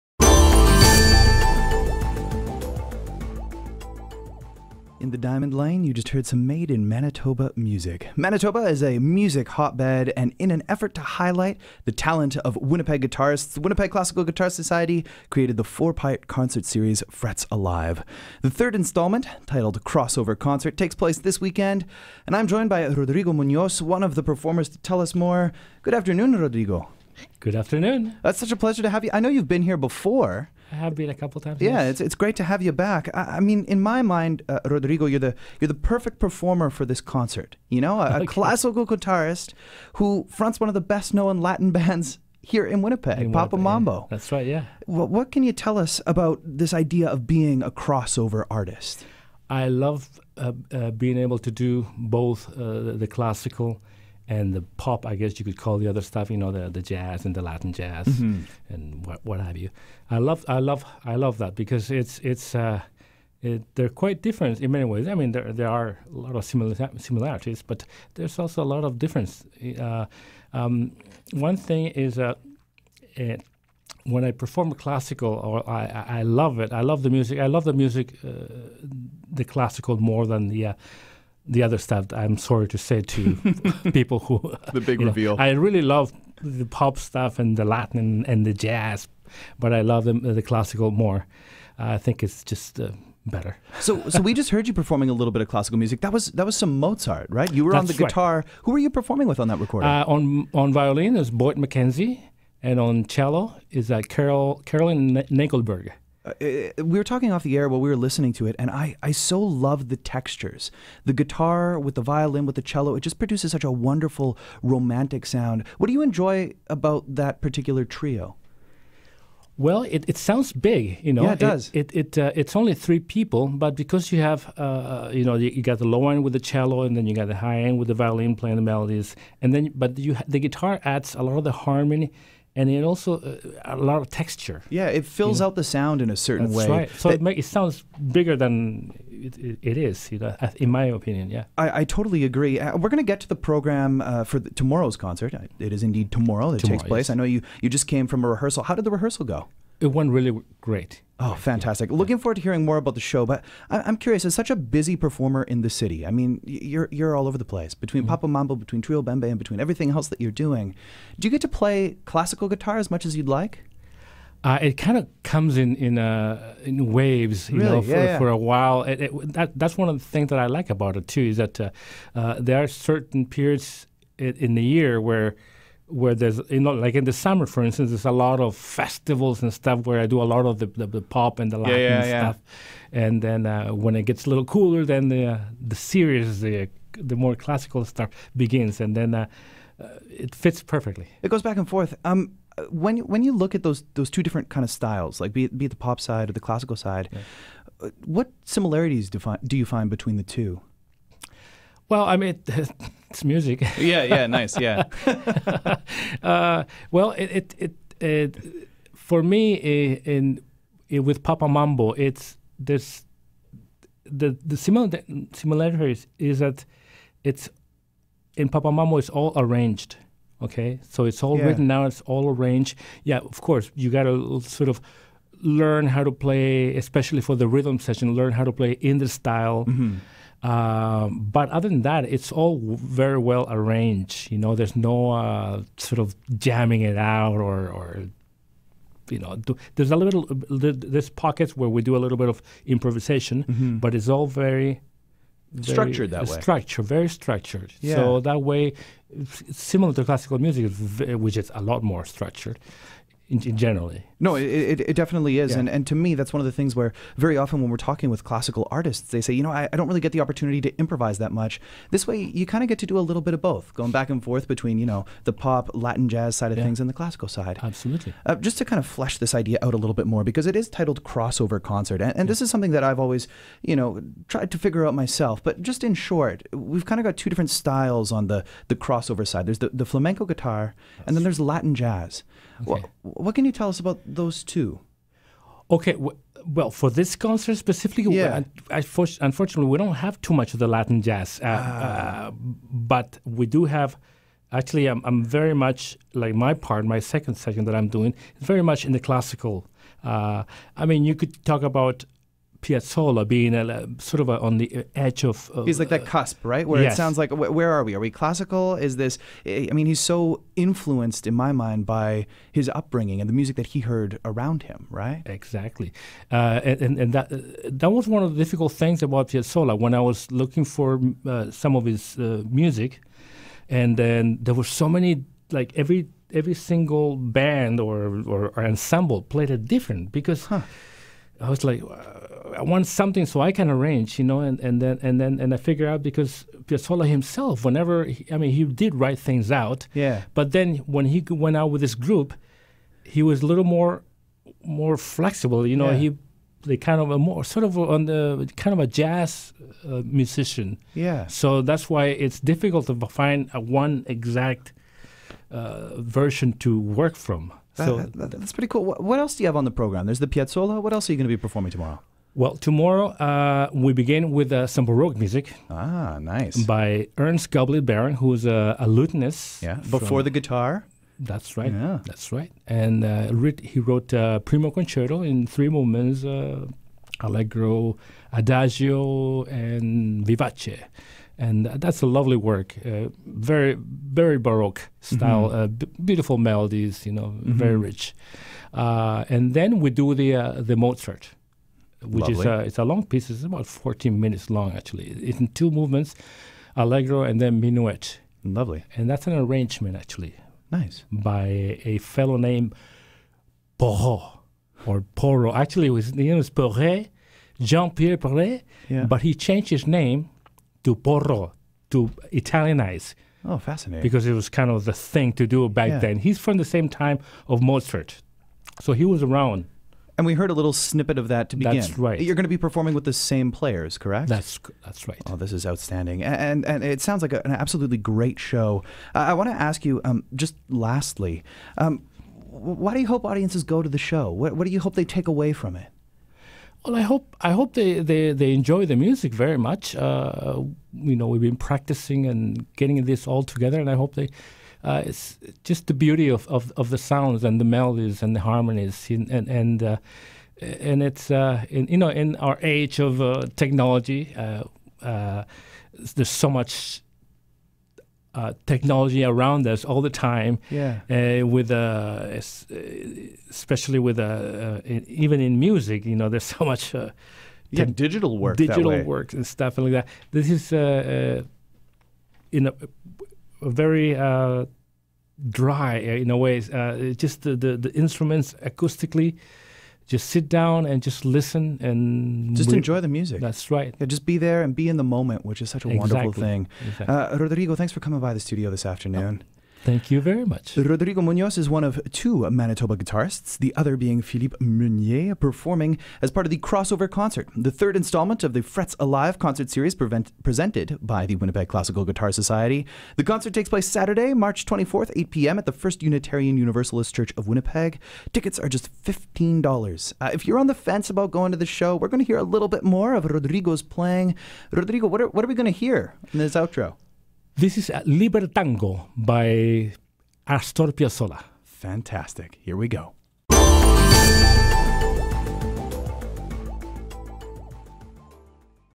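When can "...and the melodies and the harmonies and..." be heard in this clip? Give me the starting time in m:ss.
7:27.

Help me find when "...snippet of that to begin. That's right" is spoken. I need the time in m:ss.
7:00.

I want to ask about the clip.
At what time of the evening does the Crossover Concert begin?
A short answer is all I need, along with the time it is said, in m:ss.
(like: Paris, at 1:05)
8 p.m., at 8:25.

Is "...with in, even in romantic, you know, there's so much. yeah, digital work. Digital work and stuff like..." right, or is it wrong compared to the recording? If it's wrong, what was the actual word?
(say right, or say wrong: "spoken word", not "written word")
wrong: "music", not "romantic".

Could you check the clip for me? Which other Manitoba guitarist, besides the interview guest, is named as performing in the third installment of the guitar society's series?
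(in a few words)
Philippe Meunier.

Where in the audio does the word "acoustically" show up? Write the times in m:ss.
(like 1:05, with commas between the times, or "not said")
7:58.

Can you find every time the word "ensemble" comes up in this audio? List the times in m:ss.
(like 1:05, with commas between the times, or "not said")
5:28.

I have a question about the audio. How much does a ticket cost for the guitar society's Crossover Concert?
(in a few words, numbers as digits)
$15.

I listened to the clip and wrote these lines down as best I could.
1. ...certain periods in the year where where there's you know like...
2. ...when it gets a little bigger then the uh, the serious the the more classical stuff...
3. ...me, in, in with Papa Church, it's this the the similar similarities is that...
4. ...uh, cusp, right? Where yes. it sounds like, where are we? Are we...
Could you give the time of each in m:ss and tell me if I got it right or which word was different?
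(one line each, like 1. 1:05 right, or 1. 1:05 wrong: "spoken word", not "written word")
1. 2:52 right
2. 3:03 wrong: "cooler", not "bigger"
3. 3:29 wrong: "Mambo", not "Church"
4. 5:06 right.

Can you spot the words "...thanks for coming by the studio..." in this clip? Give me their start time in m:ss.
8:07.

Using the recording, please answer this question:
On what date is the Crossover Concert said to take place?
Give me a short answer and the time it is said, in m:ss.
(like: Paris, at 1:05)
March 24, at 8:24.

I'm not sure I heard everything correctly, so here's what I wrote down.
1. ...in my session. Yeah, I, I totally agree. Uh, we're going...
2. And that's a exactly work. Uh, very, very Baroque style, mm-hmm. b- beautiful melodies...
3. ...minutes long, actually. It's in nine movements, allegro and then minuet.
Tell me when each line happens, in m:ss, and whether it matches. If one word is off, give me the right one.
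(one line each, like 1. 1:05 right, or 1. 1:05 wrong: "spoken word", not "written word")
1. 2:20 wrong: "opinion", not "session"
2. 6:21 wrong: "lovely", not "exactly"
3. 6:34 wrong: "two", not "nine".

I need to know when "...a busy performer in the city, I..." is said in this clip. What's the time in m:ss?
2:34.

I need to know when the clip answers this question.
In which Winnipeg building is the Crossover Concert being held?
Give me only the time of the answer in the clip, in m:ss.
8:25.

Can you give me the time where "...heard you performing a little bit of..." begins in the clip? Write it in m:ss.
1:34.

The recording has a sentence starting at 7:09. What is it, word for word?
Uh, I want to ask you, um, just lastly, um, why do you hope audiences go to the show?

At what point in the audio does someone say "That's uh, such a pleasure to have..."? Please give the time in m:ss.
0:28.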